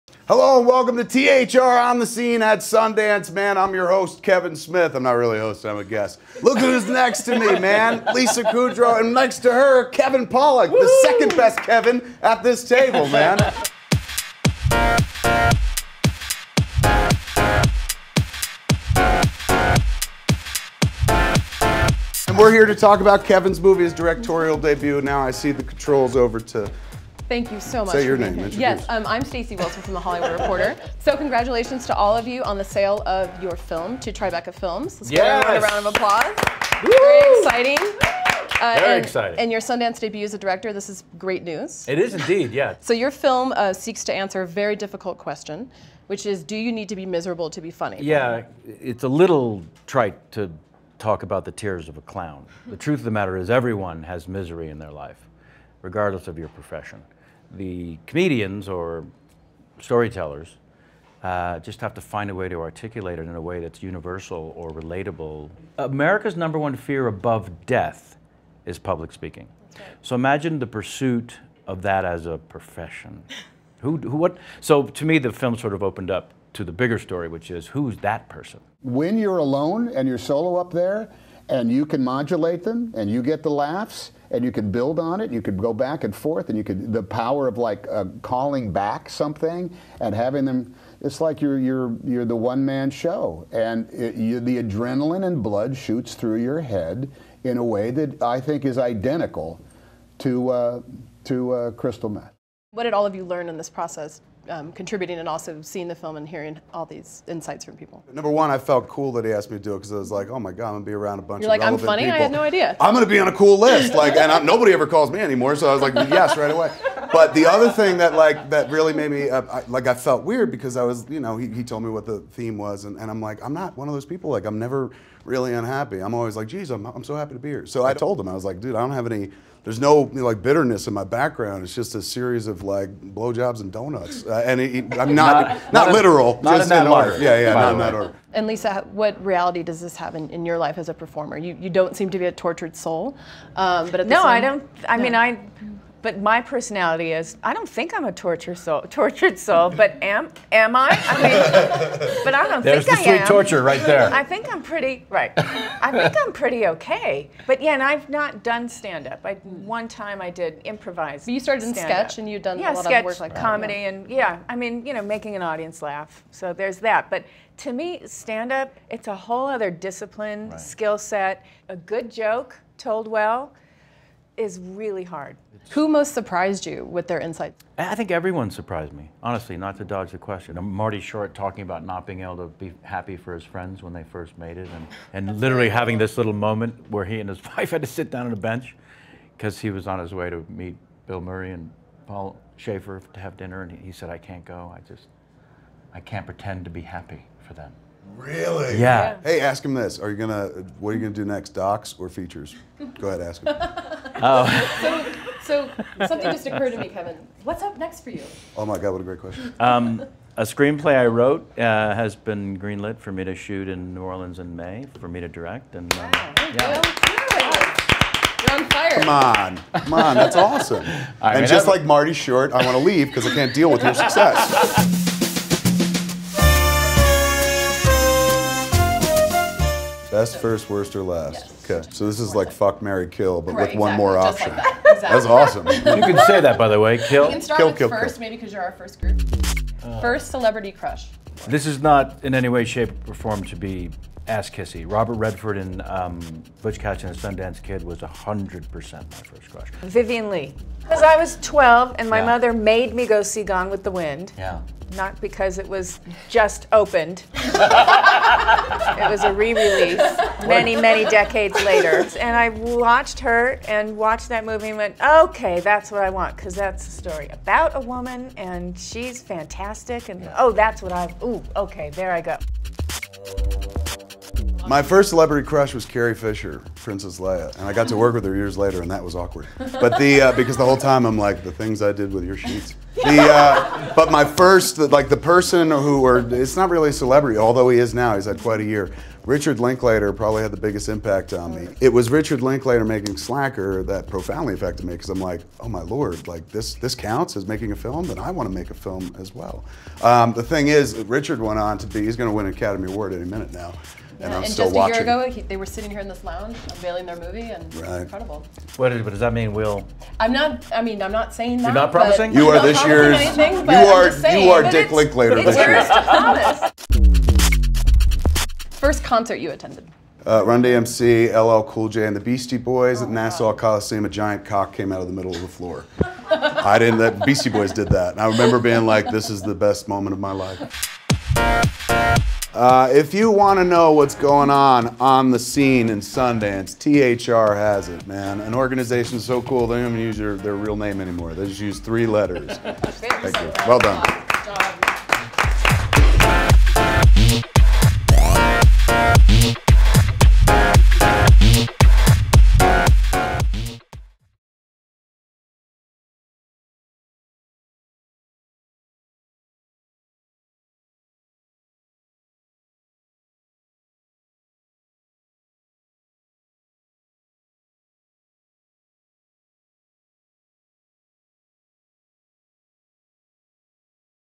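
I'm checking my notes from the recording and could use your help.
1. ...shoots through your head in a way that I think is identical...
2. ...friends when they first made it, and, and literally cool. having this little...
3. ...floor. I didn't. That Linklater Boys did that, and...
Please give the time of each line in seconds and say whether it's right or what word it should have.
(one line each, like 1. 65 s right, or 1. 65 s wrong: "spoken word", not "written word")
1. 95 s right
2. 183 s right
3. 325 s wrong: "Beastie", not "Linklater".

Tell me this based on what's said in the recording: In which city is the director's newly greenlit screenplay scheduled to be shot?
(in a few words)
New Orleans.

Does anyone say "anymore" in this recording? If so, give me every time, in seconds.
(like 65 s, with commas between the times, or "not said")
115 s, 340 s.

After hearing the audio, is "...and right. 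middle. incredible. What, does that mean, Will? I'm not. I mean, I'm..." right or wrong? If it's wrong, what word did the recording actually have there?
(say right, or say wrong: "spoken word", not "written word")
wrong: "incredible", not "middle".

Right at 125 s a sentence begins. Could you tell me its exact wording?
I'm always like geez I'm I'm so happy to be here.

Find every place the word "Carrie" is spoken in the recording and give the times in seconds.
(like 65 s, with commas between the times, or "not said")
275 s.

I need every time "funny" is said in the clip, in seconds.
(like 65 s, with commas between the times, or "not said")
47 s, 111 s.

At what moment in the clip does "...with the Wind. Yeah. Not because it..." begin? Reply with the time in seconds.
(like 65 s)
253 s.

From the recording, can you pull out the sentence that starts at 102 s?
What did all of you learn in this process?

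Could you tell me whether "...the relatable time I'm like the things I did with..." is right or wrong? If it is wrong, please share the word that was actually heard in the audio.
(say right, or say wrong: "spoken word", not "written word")
wrong: "whole", not "relatable".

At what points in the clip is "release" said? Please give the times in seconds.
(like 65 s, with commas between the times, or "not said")
259 s.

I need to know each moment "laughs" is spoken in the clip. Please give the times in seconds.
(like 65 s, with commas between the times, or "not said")
83 s, 165 s.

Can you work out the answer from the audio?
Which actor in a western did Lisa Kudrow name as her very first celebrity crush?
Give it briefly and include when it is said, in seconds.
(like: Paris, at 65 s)
Robert Redford, at 244 s.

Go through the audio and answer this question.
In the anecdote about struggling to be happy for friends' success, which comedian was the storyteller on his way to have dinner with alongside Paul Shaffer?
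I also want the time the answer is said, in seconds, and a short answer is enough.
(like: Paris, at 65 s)
Bill Murray, at 191 s.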